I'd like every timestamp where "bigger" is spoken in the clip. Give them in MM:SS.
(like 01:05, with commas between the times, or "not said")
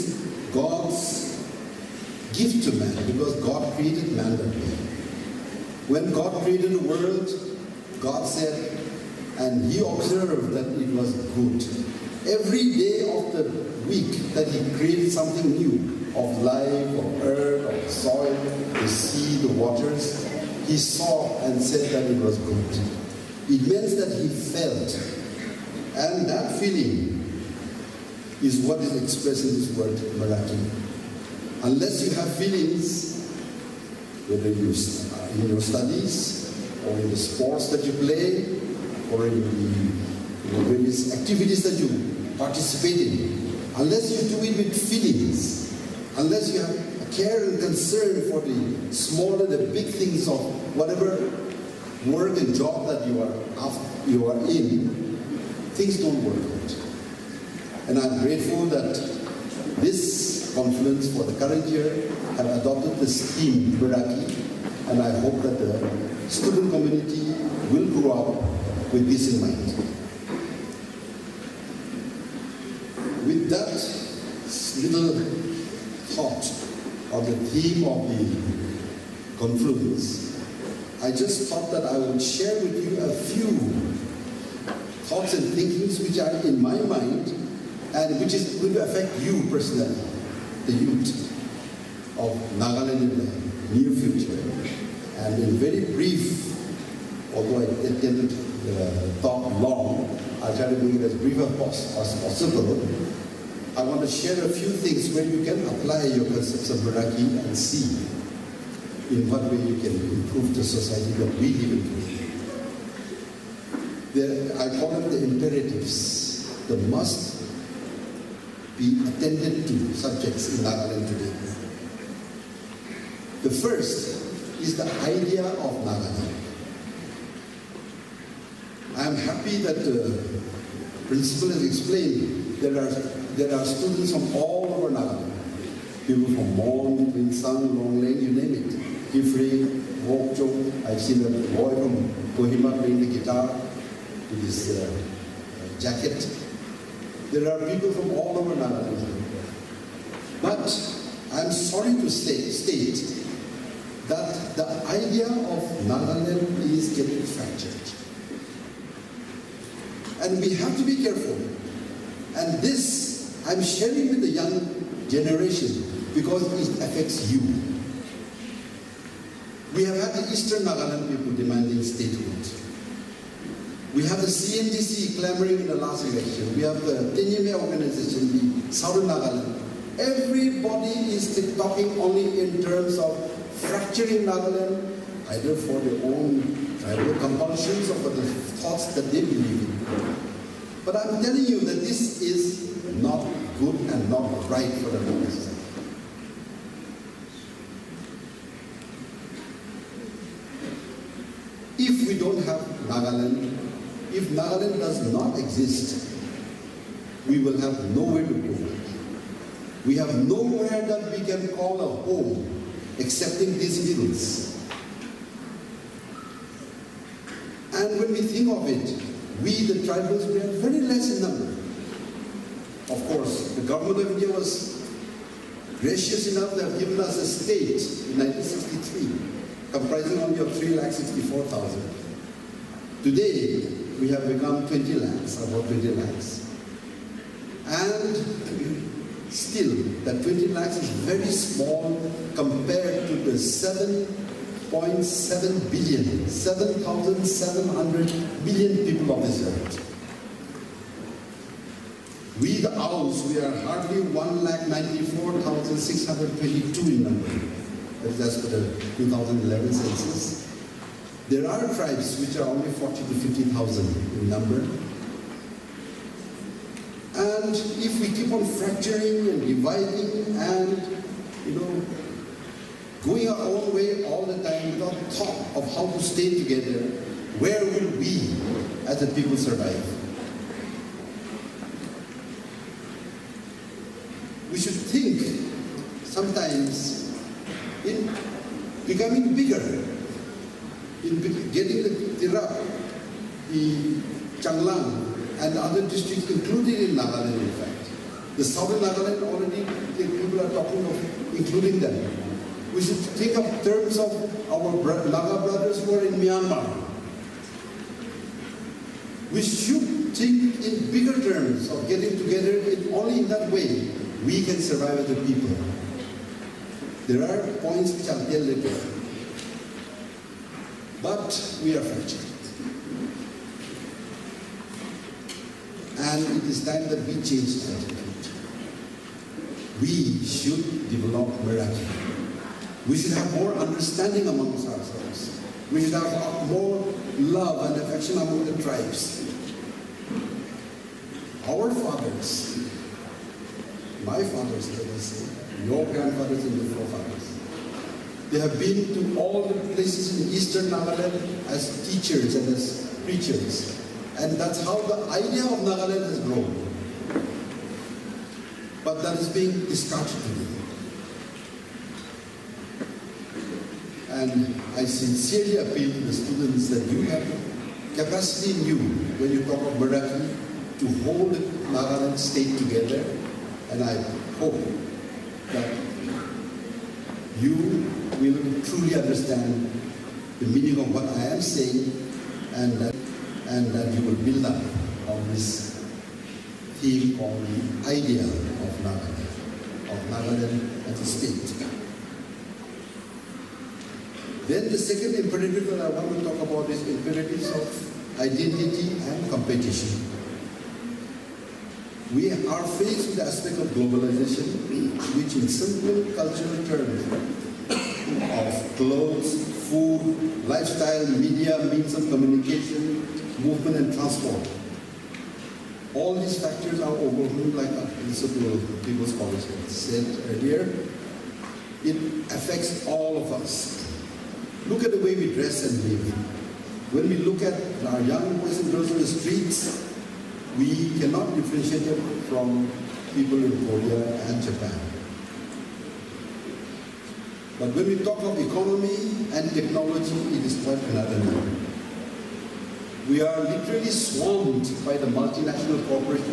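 04:49, 05:10.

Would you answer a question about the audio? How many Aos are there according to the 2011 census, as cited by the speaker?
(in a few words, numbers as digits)
1,94,622.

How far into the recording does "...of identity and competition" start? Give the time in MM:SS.
06:37.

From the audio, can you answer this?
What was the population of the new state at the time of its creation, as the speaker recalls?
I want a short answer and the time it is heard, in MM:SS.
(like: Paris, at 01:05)
3,64,000, at 03:50.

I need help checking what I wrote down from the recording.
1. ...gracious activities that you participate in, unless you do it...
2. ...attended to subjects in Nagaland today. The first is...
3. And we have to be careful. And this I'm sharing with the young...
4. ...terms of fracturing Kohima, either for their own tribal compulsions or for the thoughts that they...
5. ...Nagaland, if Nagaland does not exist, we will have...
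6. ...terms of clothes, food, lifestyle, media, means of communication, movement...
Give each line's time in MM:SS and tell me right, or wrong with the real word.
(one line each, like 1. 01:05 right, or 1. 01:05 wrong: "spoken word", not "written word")
1. 00:40 wrong: "various", not "gracious"
2. 01:59 right
3. 02:40 right
4. 03:02 wrong: "Nagaland", not "Kohima"
5. 03:22 right
6. 06:46 right.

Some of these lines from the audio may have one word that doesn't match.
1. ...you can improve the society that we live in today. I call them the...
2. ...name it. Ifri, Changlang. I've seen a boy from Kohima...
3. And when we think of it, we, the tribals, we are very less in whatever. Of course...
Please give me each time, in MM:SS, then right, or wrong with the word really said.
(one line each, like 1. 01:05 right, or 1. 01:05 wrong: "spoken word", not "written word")
1. 01:49 right
2. 02:18 wrong: "Wokcho", not "Changlang"
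3. 03:37 wrong: "number", not "whatever".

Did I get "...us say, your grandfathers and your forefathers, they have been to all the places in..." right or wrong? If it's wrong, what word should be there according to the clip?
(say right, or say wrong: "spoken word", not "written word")
right.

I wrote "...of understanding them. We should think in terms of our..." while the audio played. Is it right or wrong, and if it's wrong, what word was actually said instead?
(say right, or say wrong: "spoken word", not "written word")
wrong: "including", not "understanding".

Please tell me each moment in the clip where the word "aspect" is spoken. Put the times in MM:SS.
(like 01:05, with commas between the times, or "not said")
06:43.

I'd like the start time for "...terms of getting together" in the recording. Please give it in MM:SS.
05:11.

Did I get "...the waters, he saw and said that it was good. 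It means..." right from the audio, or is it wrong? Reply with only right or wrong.
right.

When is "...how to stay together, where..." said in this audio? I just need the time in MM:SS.
04:35.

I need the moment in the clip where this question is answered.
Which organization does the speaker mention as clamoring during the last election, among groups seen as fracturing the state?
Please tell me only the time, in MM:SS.
02:54.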